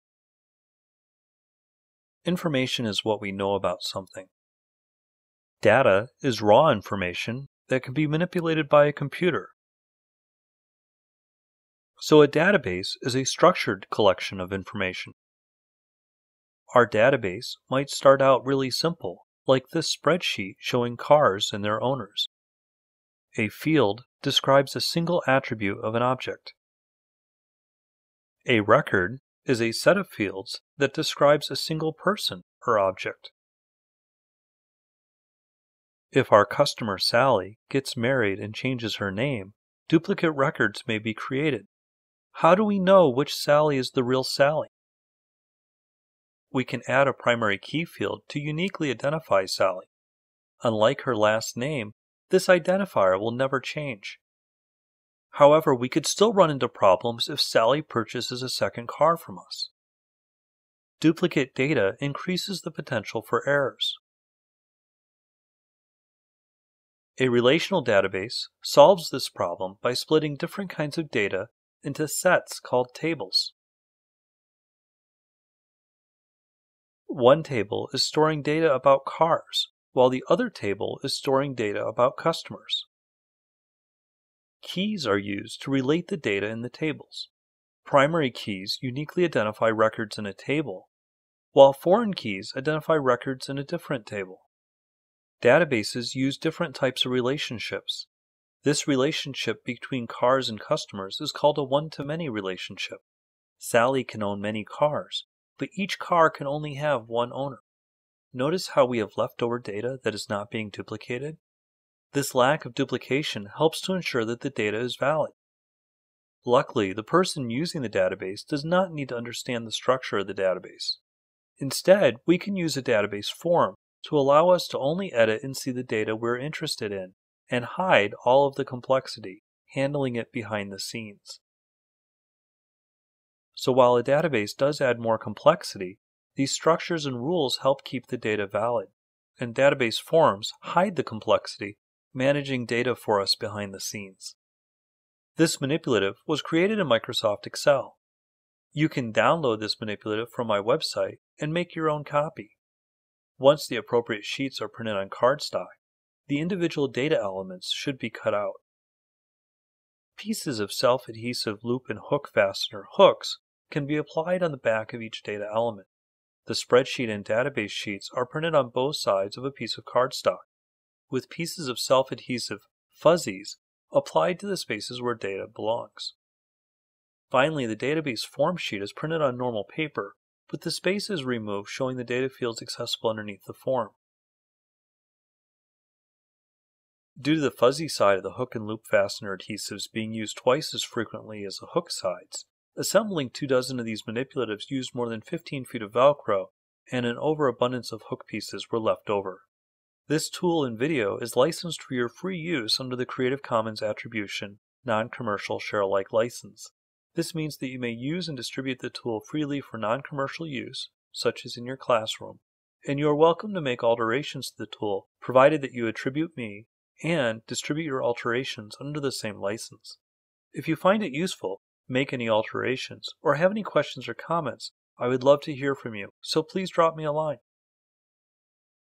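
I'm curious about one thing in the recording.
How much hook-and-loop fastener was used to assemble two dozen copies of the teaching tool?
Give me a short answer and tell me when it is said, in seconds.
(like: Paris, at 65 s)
more than 15 feet, at 194 s.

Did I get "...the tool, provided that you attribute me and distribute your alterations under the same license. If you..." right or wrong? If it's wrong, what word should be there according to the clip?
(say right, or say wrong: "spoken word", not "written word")
right.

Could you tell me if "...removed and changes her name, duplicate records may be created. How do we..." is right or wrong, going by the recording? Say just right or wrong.
wrong.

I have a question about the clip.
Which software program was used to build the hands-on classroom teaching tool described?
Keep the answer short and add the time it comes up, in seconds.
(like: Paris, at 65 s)
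Microsoft Excel, at 146 s.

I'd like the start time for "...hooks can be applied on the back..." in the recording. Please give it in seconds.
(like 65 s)
162 s.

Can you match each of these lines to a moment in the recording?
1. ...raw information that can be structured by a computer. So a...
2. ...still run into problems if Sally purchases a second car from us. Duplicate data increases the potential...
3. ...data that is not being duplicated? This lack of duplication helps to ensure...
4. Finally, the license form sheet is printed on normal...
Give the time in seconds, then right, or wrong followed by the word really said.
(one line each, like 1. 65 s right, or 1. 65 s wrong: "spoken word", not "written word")
1. 6 s wrong: "manipulated", not "structured"
2. 56 s right
3. 109 s right
4. 177 s wrong: "database", not "license".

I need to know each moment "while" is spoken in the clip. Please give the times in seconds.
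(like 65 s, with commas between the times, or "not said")
79 s, 91 s, 133 s.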